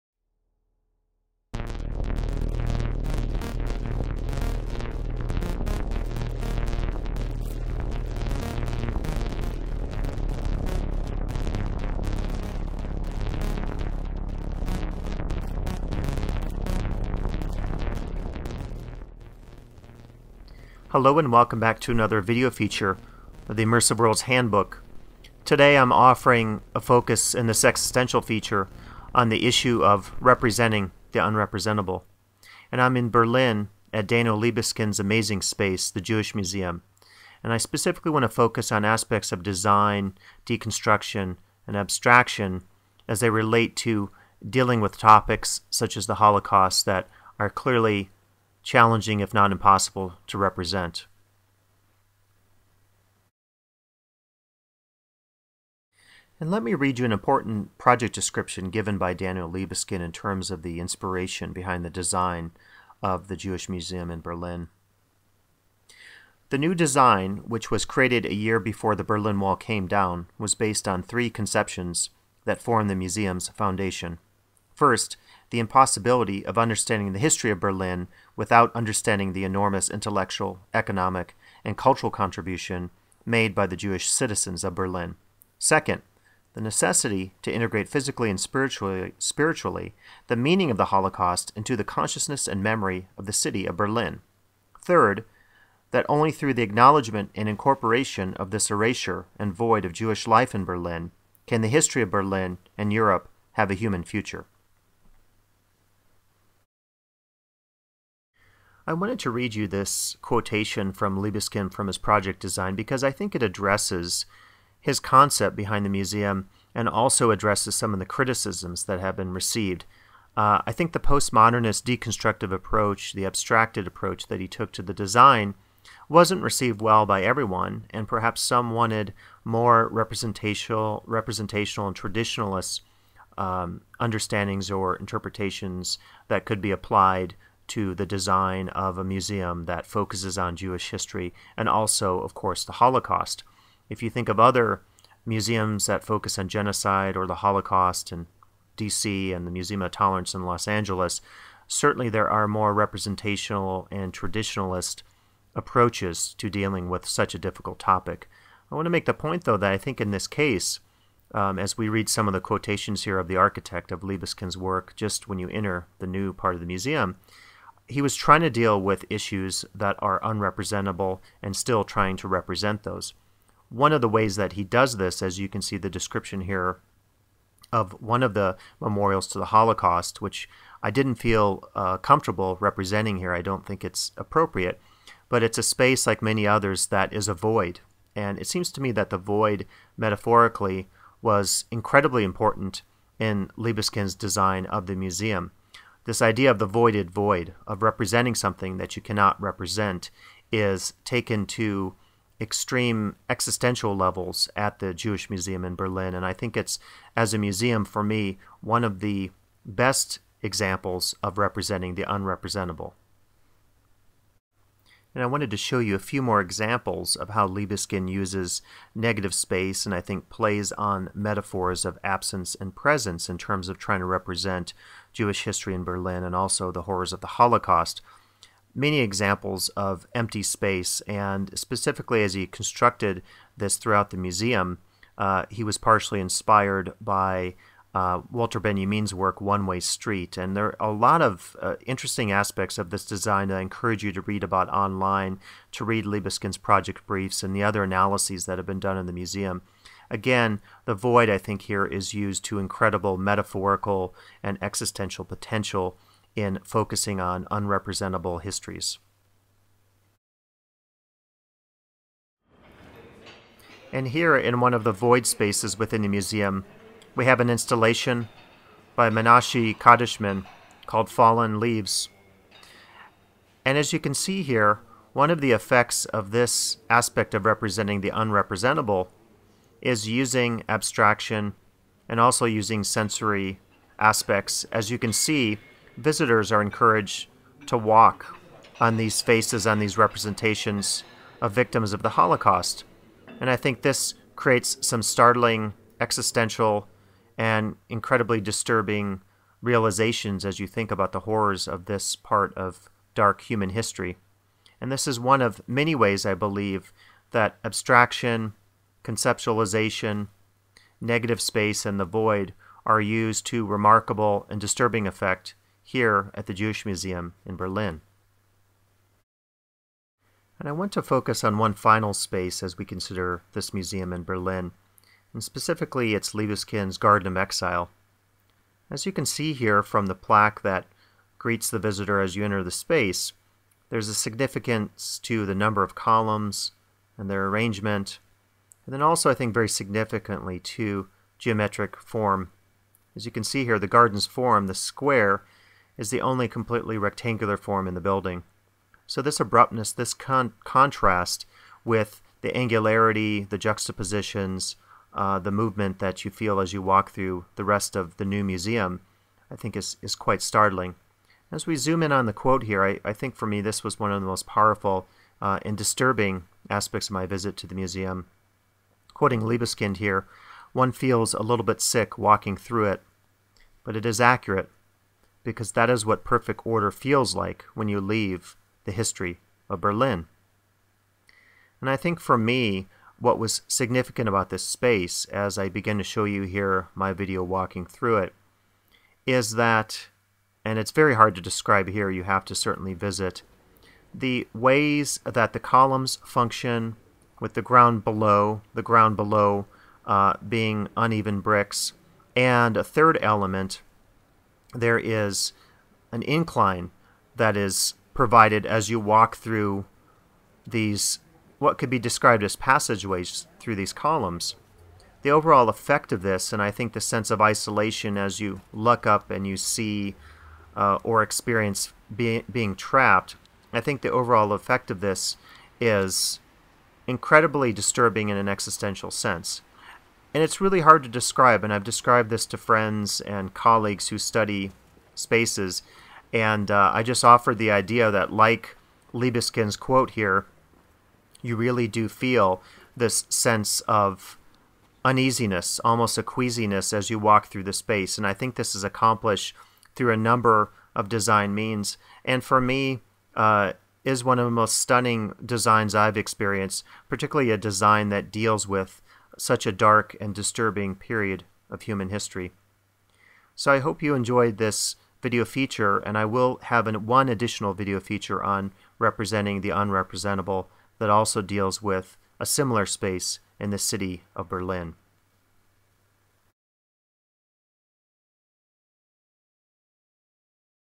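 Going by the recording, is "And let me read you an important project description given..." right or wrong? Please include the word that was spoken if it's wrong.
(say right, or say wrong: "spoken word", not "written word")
right.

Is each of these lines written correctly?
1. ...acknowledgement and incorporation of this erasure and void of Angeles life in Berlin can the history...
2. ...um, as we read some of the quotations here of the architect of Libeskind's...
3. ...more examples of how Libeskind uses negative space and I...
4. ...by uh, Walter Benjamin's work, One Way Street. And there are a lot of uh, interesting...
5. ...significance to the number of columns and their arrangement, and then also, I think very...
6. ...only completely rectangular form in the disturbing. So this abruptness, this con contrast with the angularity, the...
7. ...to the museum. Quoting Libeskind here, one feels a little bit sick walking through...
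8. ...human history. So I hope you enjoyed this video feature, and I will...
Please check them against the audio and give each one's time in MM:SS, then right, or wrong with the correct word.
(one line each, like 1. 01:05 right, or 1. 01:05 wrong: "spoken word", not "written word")
1. 01:36 wrong: "Jewish", not "Angeles"
2. 02:41 right
3. 03:36 right
4. 03:57 right
5. 05:34 right
6. 05:46 wrong: "building", not "disturbing"
7. 06:07 right
8. 07:41 right.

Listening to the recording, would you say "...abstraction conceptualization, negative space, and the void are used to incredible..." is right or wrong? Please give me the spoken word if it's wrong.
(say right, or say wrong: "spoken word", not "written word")
wrong: "remarkable", not "incredible".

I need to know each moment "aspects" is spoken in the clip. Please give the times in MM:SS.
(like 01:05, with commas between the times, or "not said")
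00:38, 04:02, 04:36, 04:43, 06:06.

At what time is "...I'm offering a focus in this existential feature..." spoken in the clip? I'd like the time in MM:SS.
00:25.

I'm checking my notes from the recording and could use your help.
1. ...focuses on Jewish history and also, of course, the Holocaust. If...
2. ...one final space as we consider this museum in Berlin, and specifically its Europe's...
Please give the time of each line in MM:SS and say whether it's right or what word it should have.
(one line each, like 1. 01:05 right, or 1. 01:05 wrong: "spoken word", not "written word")
1. 02:19 right
2. 05:21 wrong: "Libeskind", not "Europe".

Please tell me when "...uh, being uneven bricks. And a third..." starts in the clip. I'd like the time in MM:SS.
06:40.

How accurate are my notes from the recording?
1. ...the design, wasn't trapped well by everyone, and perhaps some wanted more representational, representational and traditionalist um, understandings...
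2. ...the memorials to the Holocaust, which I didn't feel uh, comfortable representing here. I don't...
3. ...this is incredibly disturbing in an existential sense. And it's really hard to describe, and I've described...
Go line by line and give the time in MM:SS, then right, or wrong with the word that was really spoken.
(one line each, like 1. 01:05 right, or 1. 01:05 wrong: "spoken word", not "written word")
1. 02:04 wrong: "received", not "trapped"
2. 02:58 right
3. 07:05 right.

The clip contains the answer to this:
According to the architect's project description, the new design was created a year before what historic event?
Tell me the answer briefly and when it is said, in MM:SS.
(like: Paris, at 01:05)
The Berlin Wall came down, at 01:08.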